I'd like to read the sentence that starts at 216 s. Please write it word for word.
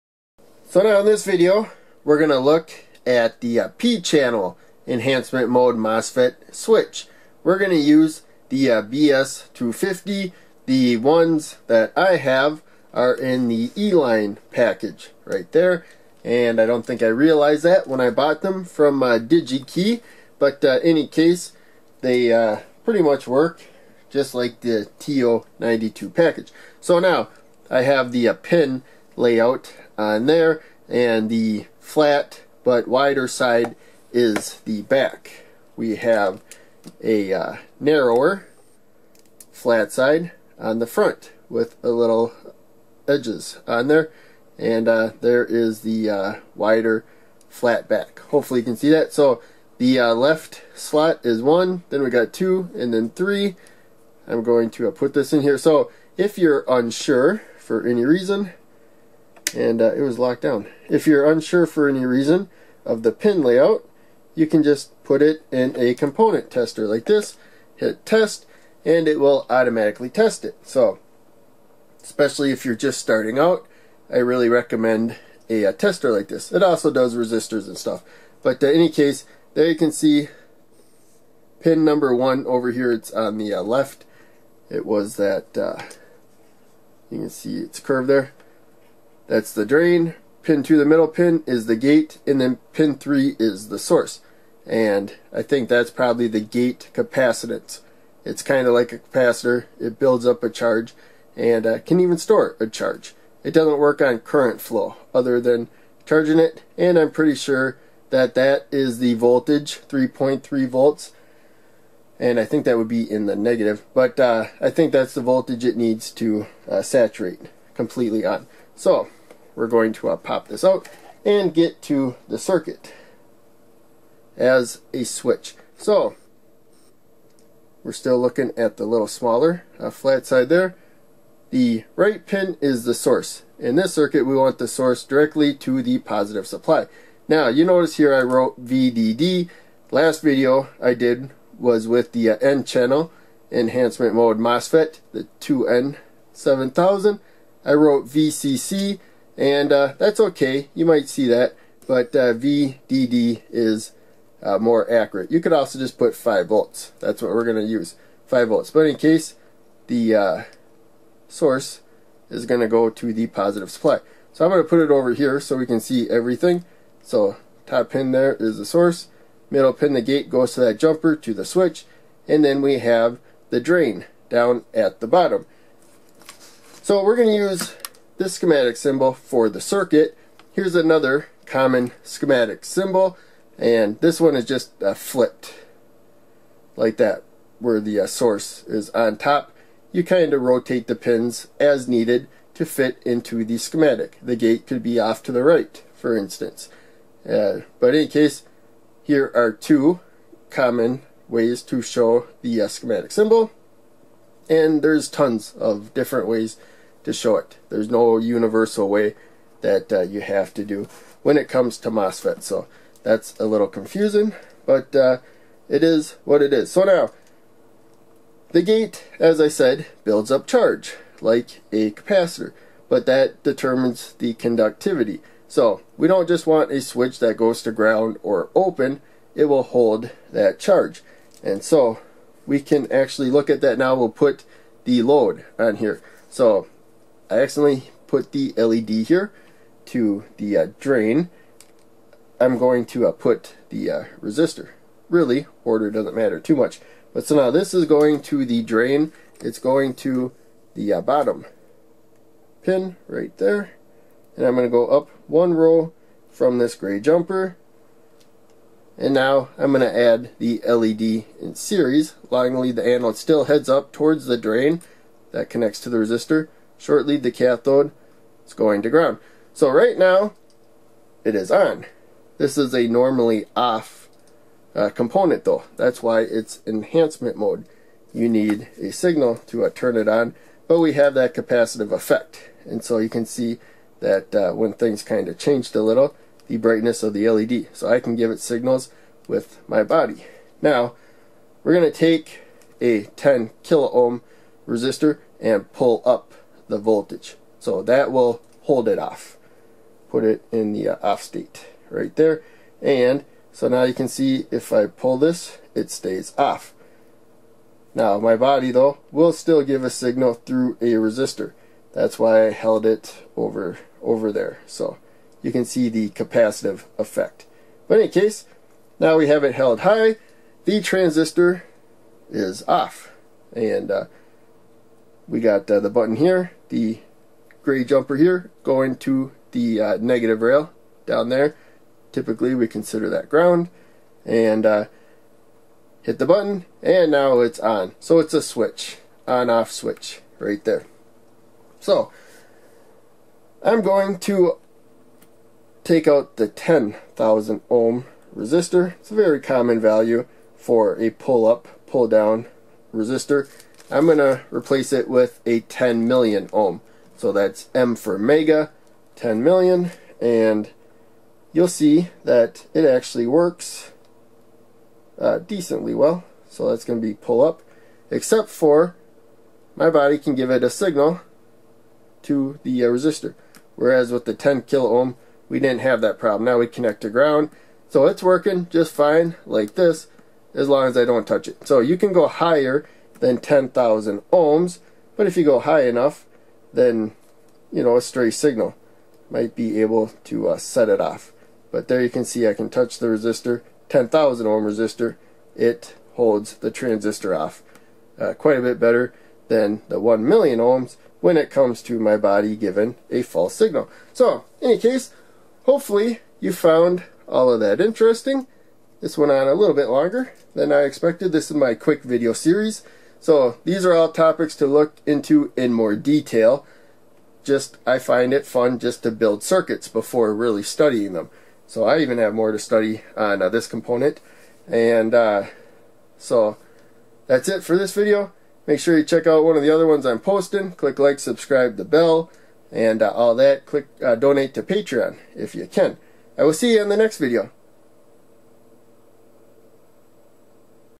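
So now, the gate, as I said, builds up charge like a capacitor, but that determines the conductivity.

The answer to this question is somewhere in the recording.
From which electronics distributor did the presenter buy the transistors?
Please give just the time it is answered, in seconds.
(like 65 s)
19 s.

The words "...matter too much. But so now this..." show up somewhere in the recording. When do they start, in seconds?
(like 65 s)
246 s.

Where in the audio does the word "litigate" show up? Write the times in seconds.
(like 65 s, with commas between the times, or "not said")
not said.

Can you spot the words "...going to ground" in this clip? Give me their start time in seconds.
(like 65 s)
268 s.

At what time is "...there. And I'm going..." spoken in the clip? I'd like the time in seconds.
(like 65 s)
253 s.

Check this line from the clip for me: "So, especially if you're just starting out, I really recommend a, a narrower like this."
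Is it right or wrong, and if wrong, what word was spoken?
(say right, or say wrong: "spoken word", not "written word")
wrong: "tester", not "narrower".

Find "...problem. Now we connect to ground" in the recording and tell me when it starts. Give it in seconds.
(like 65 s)
376 s.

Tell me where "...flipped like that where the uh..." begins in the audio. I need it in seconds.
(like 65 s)
184 s.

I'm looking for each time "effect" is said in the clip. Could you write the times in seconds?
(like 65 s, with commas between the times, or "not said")
281 s, 316 s.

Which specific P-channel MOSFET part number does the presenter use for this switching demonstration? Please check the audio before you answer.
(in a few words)
BS250.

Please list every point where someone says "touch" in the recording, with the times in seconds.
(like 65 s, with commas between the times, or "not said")
381 s, 392 s.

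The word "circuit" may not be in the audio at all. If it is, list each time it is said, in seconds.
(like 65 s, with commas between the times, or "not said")
122 s, 133 s, 179 s, 419 s.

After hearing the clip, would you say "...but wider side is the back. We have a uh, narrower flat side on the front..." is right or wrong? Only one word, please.
right.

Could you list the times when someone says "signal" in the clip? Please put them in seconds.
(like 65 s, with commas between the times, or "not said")
278 s, 288 s, 309 s, 370 s, 388 s, 403 s.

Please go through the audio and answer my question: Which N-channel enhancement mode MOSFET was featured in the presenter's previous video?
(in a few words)
2N7000.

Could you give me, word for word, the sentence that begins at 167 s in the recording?
So top pin there is the source.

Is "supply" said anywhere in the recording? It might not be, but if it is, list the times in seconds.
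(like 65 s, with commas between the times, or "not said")
136 s, 163 s.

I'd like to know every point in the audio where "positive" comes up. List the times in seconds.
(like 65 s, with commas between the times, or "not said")
135 s, 163 s.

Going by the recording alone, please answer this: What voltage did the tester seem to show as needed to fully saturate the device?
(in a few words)
3.3 volts.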